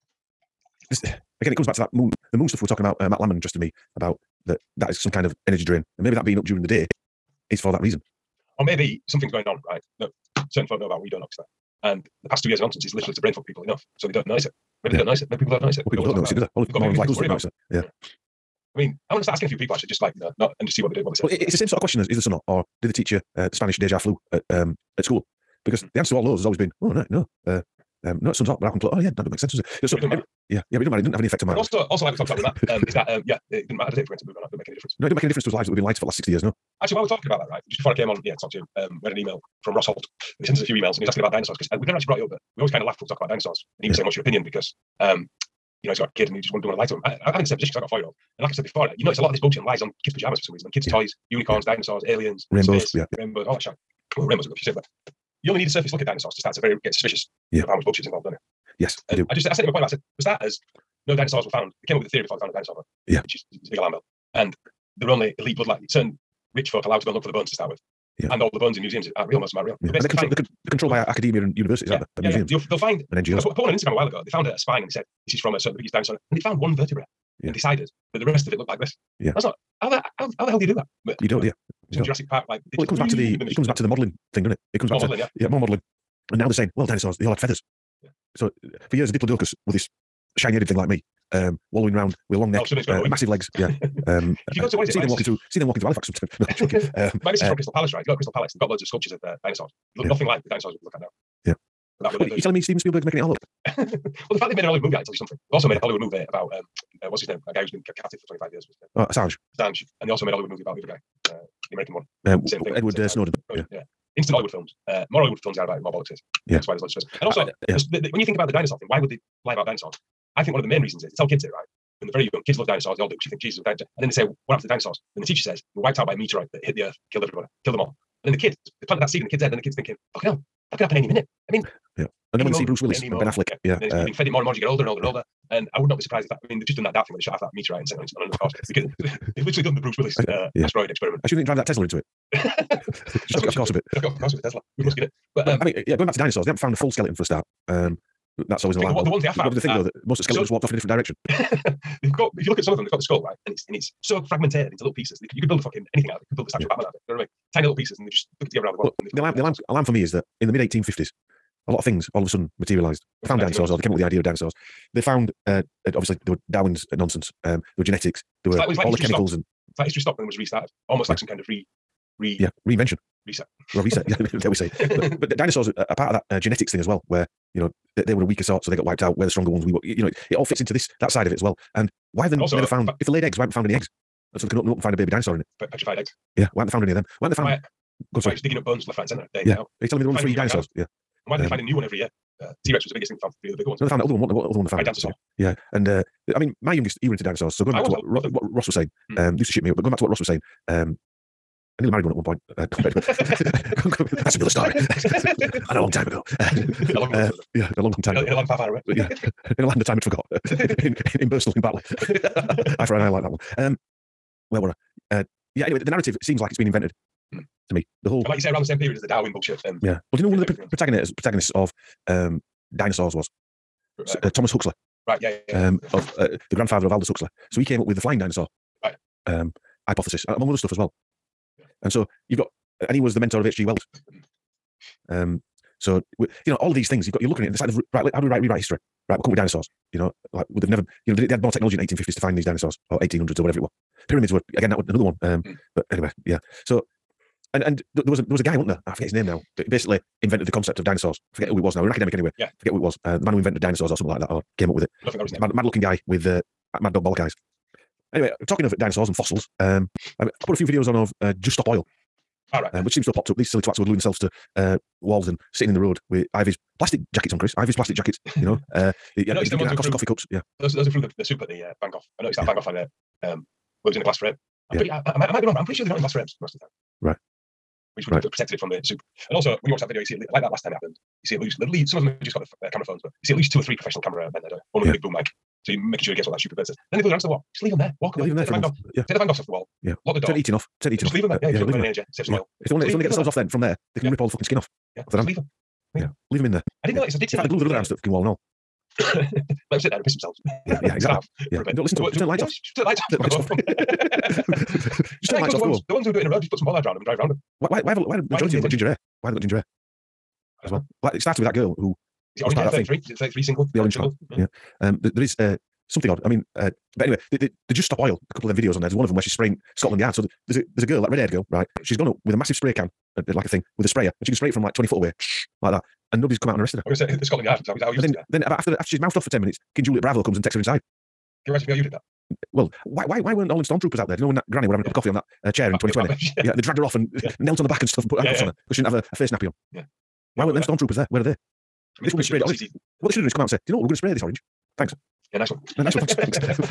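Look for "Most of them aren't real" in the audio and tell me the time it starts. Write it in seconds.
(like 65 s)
69 s.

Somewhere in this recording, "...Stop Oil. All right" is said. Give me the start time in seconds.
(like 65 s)
261 s.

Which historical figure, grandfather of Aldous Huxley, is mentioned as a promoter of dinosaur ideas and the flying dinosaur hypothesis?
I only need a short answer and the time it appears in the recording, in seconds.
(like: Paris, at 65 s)
Thomas Huxley, at 224 s.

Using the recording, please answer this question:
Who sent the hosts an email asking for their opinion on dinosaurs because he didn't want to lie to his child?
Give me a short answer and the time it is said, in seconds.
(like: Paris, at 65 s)
Ross Holt, at 39 s.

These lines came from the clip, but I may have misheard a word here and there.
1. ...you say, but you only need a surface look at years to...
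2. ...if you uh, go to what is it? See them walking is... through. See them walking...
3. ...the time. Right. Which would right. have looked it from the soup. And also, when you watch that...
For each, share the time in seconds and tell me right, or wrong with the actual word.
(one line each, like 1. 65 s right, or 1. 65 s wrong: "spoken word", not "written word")
1. 54 s wrong: "dinosaurs", not "years"
2. 94 s right
3. 276 s wrong: "protected", not "looked".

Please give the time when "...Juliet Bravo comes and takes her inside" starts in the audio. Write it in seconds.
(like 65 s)
329 s.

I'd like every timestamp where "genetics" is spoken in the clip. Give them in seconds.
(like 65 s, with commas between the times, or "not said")
167 s, 176 s.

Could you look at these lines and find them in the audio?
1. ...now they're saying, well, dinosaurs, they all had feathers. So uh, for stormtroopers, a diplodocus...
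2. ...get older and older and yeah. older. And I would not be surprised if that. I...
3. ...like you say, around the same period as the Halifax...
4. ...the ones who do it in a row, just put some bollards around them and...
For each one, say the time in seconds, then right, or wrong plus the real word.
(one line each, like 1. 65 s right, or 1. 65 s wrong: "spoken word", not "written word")
1. 86 s wrong: "years", not "stormtroopers"
2. 134 s right
3. 218 s wrong: "Darwin", not "Halifax"
4. 305 s right.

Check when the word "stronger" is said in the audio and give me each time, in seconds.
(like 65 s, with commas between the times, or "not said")
179 s.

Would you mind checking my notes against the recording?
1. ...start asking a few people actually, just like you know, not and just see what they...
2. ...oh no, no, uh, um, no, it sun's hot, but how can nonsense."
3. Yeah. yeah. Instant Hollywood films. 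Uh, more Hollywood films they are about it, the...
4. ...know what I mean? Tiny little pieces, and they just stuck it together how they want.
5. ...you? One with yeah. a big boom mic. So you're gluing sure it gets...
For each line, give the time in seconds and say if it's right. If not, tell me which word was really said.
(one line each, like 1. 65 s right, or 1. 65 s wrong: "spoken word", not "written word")
1. 19 s right
2. 26 s wrong: "close", not "nonsense"
3. 113 s right
4. 157 s right
5. 284 s wrong: "making", not "gluing".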